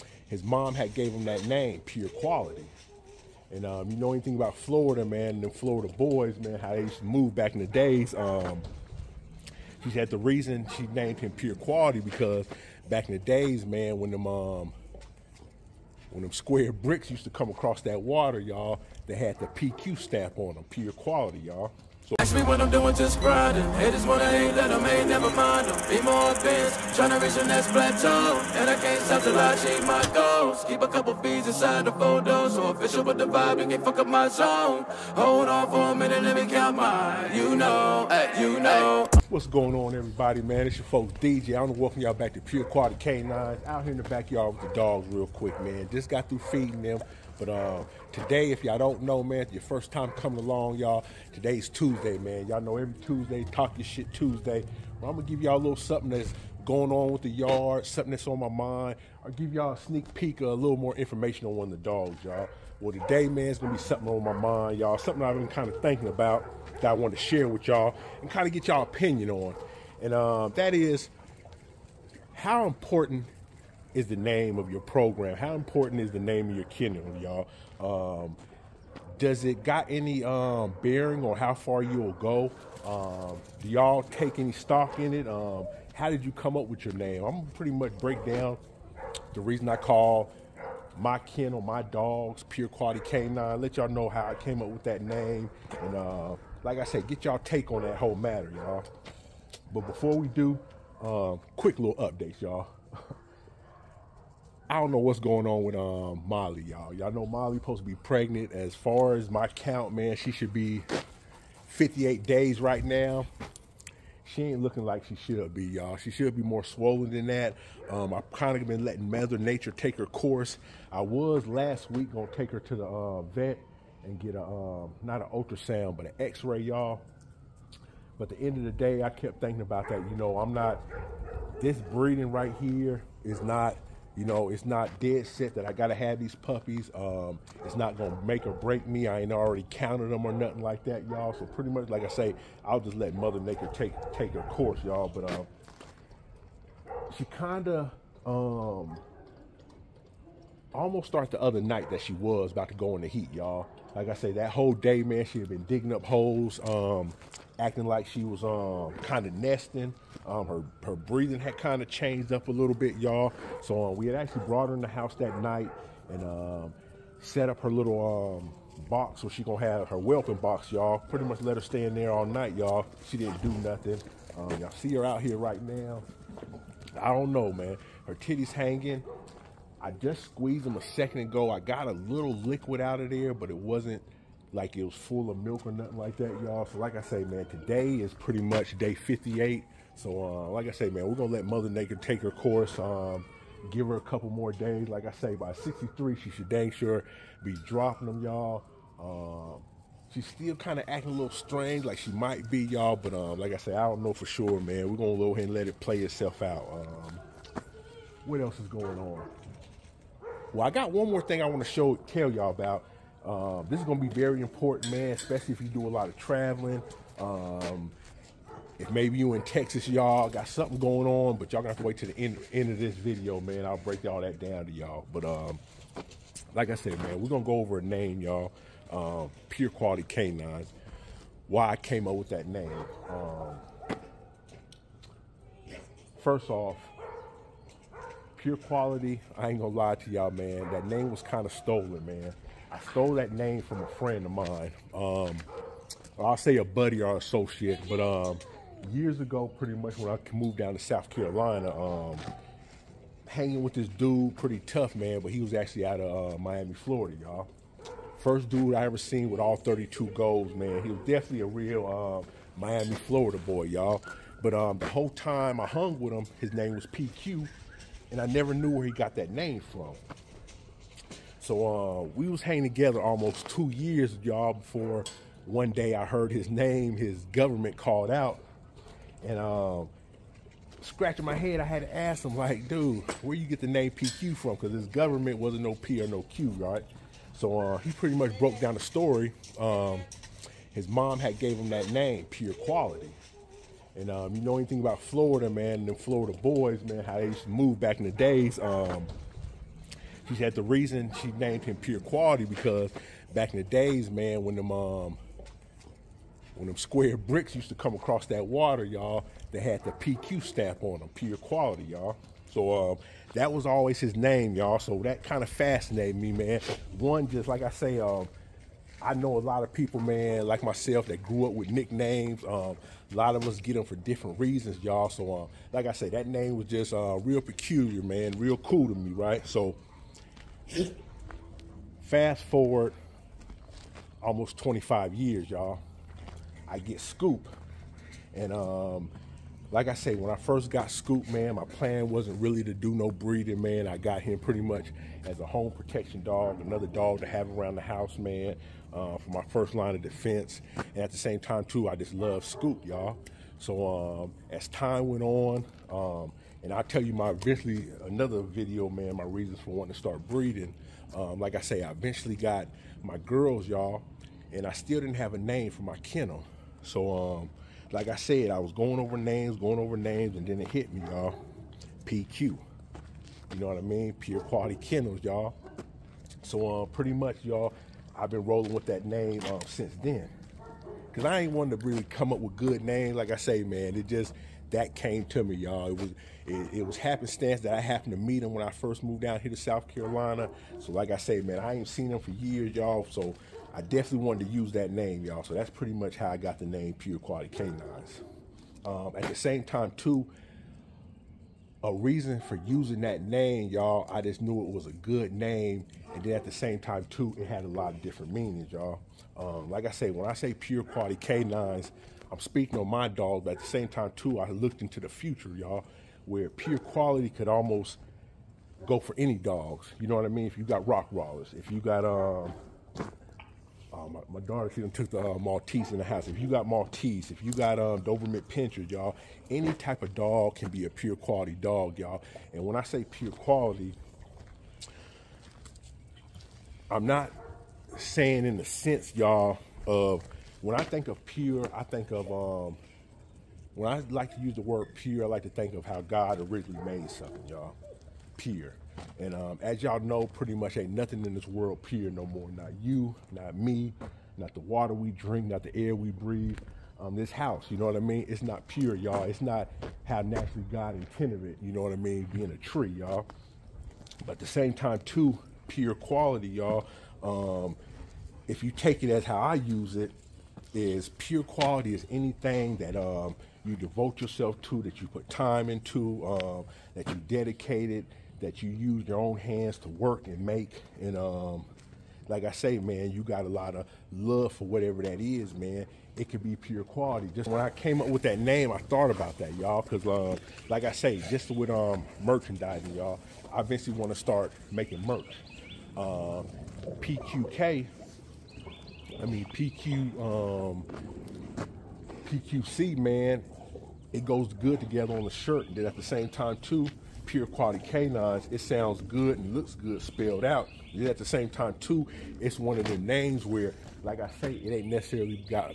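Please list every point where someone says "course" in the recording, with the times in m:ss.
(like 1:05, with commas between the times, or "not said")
2:00, 2:24, 3:12.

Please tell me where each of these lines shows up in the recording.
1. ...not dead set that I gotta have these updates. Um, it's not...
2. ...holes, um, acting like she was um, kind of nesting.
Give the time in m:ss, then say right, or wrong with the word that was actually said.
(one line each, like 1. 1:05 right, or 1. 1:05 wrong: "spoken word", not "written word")
1. 2:14 wrong: "puppies", not "updates"
2. 2:36 right.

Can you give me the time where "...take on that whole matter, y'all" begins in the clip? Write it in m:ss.
1:37.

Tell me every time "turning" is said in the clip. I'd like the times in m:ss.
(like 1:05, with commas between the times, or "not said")
not said.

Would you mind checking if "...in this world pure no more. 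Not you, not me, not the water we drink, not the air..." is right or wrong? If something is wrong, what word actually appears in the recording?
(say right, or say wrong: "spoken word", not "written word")
right.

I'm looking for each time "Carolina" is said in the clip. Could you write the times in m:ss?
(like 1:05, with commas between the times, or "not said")
4:11, 6:29.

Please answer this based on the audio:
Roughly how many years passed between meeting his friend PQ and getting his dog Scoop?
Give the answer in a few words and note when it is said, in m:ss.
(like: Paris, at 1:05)
25, at 5:34.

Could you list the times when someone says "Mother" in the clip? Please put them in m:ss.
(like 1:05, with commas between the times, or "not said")
1:59, 2:23, 3:11.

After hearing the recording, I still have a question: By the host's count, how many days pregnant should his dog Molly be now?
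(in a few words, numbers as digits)
58.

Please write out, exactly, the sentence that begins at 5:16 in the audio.
One, just like I say, um, I know a lot of people, man, like myself, that grew up with nicknames.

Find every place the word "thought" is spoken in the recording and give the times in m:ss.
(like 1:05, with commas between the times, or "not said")
8:08.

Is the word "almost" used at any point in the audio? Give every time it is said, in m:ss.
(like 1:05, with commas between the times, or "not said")
2:30, 4:33, 5:34, 6:57.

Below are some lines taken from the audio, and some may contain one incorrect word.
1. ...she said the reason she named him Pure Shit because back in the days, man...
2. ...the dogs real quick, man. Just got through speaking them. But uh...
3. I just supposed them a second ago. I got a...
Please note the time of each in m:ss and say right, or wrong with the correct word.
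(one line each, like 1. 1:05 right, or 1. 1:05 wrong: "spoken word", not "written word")
1. 0:09 wrong: "Quality", not "Shit"
2. 0:44 wrong: "feeding", not "speaking"
3. 2:59 wrong: "squeezed", not "supposed".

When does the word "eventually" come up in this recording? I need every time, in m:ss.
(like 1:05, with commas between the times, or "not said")
5:57, 6:01, 8:13.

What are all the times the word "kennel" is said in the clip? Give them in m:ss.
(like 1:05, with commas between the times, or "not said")
1:16, 1:31, 6:05, 6:14.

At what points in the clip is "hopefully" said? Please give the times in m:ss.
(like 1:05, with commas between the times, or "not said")
not said.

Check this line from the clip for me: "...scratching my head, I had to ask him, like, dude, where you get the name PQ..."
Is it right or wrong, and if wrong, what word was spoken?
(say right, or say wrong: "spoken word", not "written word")
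right.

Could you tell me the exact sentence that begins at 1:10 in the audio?
And um, that is how important is the name of your program?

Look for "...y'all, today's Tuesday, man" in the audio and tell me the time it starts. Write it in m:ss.
0:50.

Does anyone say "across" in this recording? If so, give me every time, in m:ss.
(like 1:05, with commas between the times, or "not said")
0:17, 5:07.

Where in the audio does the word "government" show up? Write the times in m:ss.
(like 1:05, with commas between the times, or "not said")
4:37, 4:44.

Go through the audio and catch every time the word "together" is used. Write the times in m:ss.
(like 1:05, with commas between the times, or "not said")
4:32, 8:24.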